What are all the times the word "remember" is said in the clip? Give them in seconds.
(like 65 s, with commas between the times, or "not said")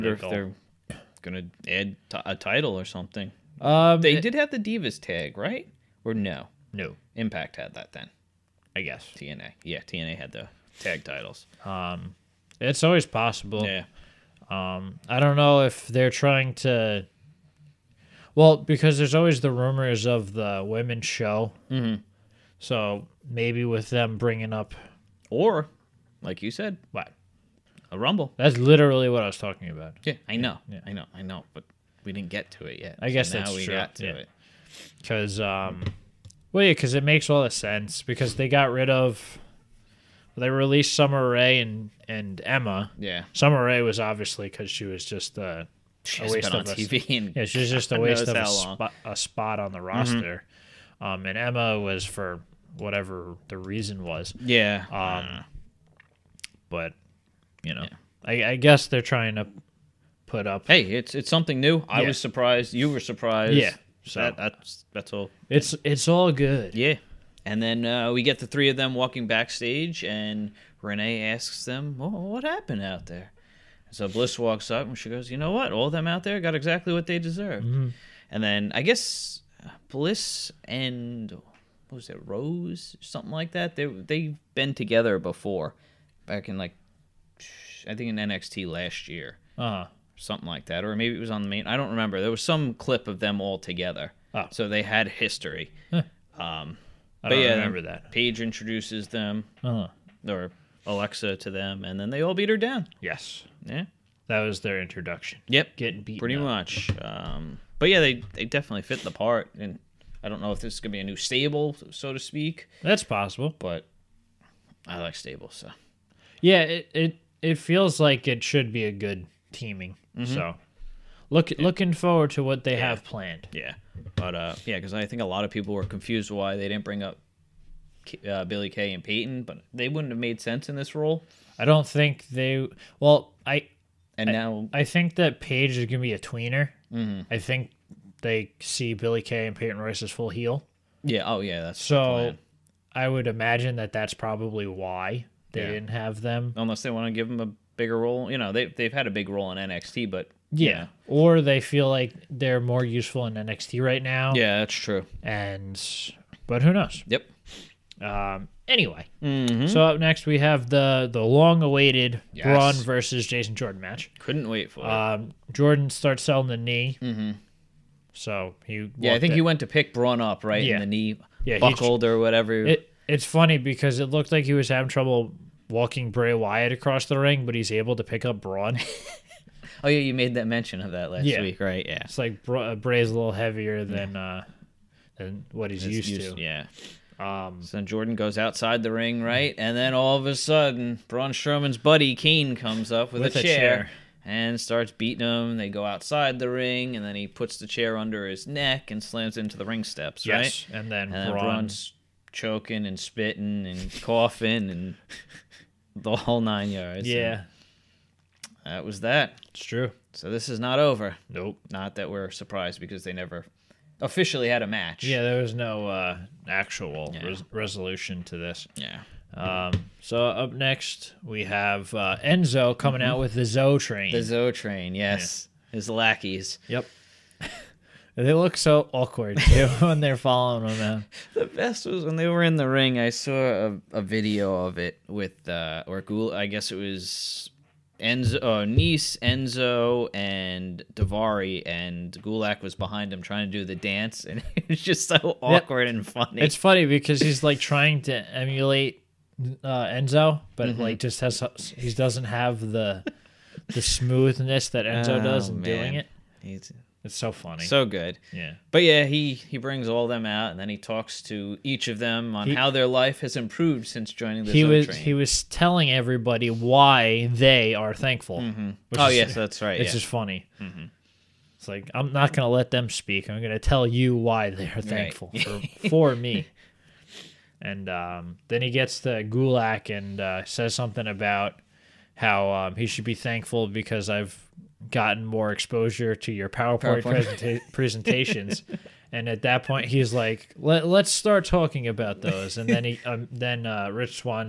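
91 s, 97 s.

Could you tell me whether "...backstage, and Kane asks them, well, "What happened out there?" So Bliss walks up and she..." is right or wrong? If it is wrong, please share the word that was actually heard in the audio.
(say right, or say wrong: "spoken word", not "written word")
wrong: "Renee", not "Kane".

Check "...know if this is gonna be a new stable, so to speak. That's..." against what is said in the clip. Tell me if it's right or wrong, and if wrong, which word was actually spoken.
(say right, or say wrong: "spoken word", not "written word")
right.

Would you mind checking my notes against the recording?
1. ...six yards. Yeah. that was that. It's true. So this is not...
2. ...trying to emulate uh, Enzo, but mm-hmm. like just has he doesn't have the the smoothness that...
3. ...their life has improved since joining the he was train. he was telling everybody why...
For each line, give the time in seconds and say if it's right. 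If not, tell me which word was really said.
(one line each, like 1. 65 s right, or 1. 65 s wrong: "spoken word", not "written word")
1. 206 s wrong: "nine", not "six"
2. 247 s right
3. 262 s right.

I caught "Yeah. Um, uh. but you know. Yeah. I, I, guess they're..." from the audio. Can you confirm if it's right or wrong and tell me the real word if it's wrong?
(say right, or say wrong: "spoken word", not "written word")
right.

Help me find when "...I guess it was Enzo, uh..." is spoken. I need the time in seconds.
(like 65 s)
236 s.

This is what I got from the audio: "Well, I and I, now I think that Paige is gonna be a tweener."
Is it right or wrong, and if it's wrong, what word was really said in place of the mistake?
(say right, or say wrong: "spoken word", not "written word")
right.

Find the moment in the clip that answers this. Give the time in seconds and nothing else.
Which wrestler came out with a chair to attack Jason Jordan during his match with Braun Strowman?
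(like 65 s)
192 s.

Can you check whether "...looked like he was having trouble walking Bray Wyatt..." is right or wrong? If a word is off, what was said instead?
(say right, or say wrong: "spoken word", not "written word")
right.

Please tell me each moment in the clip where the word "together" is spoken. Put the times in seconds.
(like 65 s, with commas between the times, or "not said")
84 s, 93 s.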